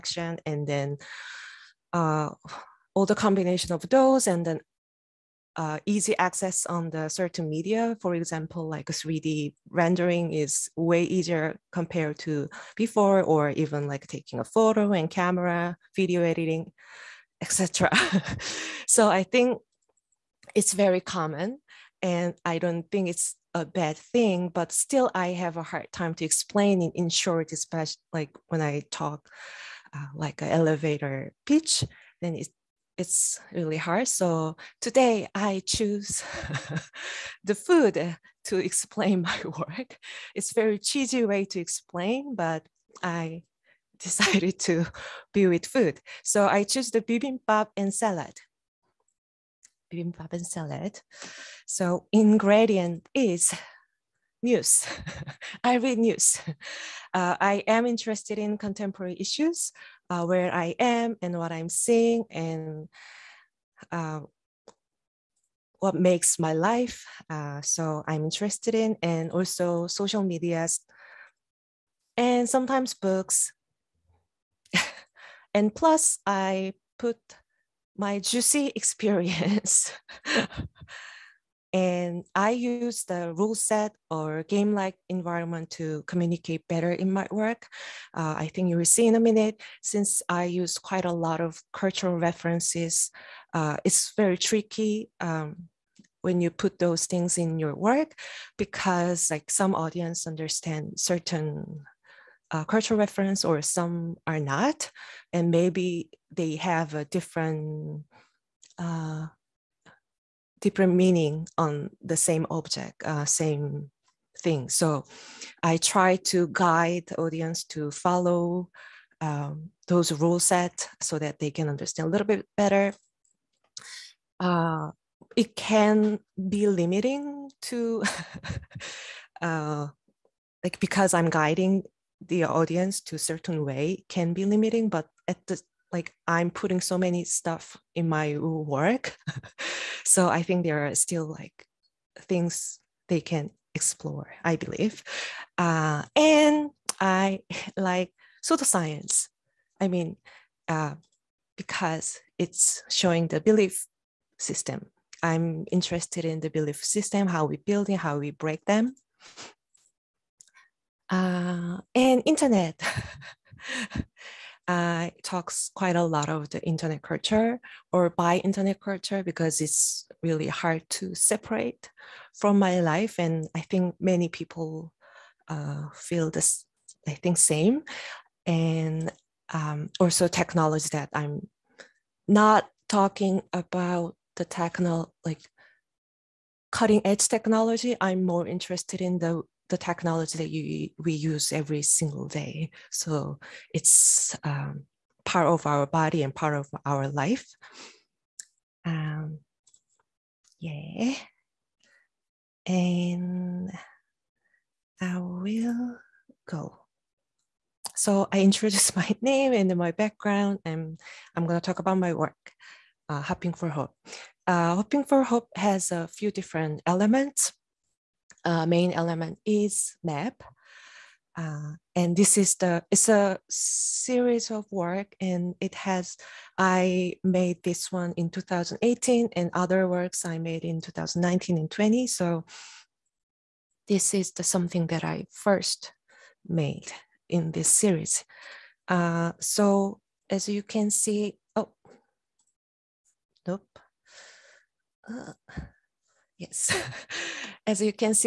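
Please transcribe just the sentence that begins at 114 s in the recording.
So I try to guide audience to follow um, those rule set so that they can understand a little bit better.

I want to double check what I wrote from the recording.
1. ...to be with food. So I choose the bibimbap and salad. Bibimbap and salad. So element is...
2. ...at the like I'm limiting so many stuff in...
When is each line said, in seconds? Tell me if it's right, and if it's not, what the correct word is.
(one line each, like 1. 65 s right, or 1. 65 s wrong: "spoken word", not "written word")
1. 44 s wrong: "ingredient", not "element"
2. 135 s wrong: "putting", not "limiting".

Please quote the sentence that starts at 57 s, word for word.
Uh, I am interested in contemporary issues uh, where I am and what I'm seeing and uh, what makes my life.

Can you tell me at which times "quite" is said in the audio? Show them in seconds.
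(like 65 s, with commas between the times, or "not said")
90 s, 165 s.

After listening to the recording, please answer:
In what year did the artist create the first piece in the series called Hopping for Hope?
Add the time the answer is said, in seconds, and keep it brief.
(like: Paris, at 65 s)
2018, at 228 s.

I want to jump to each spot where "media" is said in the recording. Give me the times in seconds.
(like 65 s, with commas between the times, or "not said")
7 s, 70 s.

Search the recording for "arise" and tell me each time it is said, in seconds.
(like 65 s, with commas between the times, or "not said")
not said.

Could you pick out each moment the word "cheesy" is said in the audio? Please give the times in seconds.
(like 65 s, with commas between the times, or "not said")
40 s.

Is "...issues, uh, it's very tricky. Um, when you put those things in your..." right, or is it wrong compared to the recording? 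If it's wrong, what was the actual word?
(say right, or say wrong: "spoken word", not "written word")
wrong: "references", not "issues".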